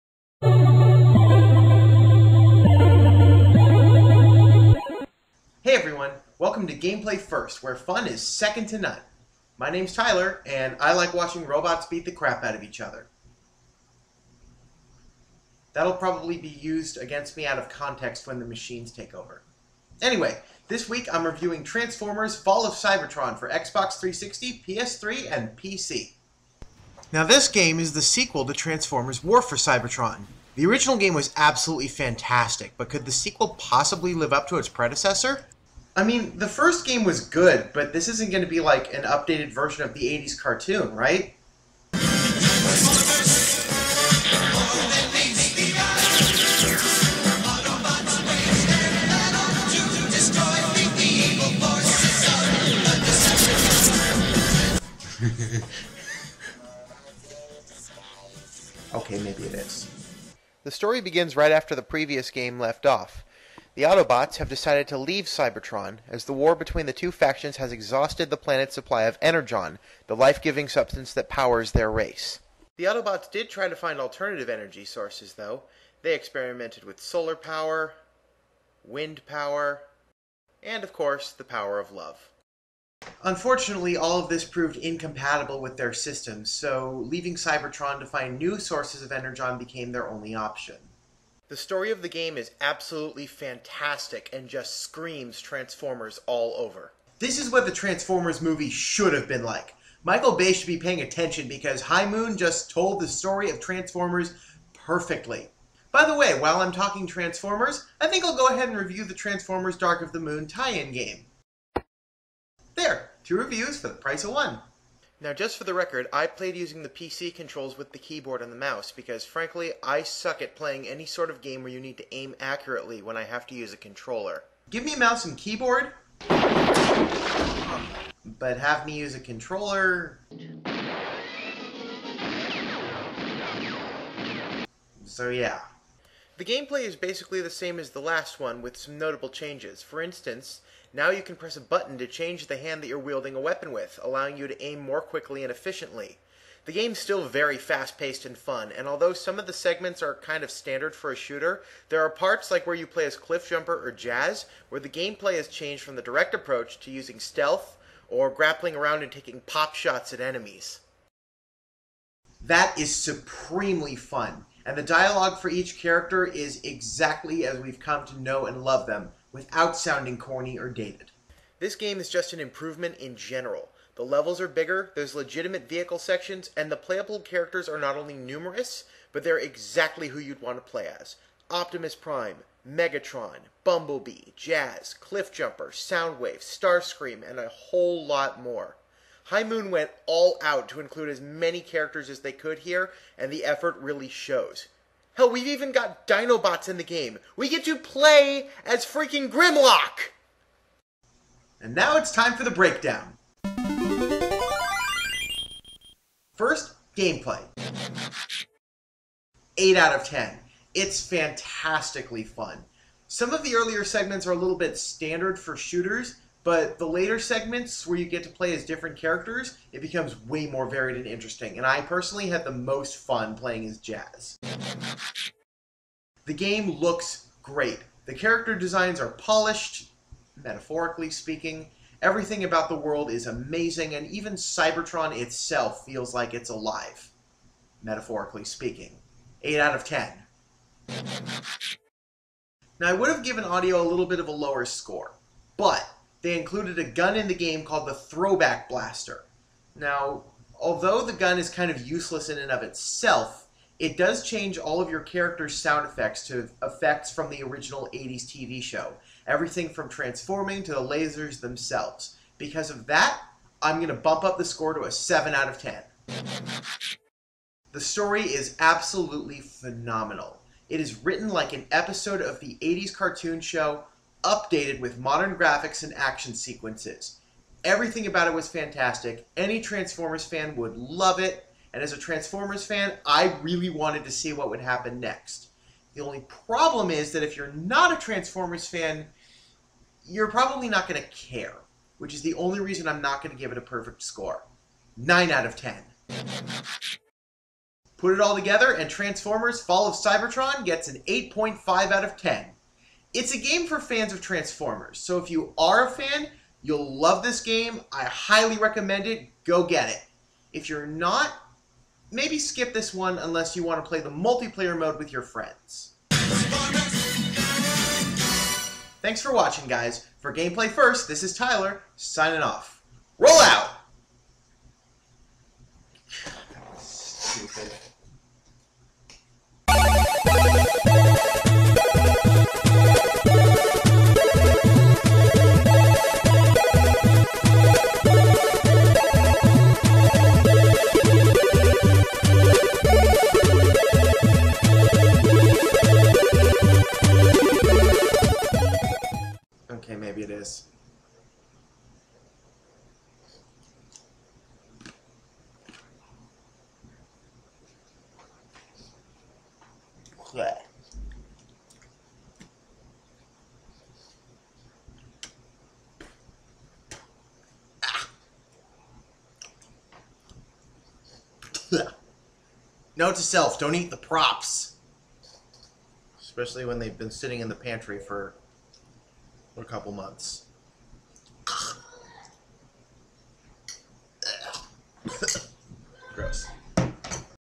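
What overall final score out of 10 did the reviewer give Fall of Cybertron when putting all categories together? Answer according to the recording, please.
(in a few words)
8.5.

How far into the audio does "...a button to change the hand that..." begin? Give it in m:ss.
2:21.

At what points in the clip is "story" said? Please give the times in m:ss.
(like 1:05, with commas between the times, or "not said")
1:00, 1:31, 1:43, 4:27.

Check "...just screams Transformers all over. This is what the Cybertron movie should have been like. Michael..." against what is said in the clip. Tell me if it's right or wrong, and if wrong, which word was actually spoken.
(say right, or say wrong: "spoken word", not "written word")
wrong: "Transformers", not "Cybertron".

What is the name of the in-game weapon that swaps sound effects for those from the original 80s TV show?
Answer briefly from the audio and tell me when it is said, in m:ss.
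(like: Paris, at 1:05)
Throwback Blaster, at 4:07.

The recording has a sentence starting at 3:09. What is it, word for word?
High Moon went all out to include as many characters as they could here, and the effort really shows.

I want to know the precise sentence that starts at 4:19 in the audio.
Everything from transforming to the lasers themselves.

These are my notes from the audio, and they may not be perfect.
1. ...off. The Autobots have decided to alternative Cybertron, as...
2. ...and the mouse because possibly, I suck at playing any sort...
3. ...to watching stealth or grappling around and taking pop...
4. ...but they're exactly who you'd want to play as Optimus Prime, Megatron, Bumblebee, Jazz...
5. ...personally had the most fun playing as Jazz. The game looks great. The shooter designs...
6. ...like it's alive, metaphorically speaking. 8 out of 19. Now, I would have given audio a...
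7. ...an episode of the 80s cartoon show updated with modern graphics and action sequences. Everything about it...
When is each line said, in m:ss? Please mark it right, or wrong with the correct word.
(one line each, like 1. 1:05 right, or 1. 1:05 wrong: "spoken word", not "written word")
1. 1:02 wrong: "leave", not "alternative"
2. 1:58 wrong: "frankly", not "possibly"
3. 2:36 wrong: "using", not "watching"
4. 2:59 right
5. 3:41 wrong: "character", not "shooter"
6. 3:56 wrong: "10", not "19"
7. 4:31 right.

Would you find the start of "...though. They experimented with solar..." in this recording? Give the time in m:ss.
1:15.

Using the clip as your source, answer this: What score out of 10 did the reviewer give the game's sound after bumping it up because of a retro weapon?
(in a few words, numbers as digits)
7.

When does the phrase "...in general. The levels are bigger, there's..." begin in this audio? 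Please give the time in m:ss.
2:52.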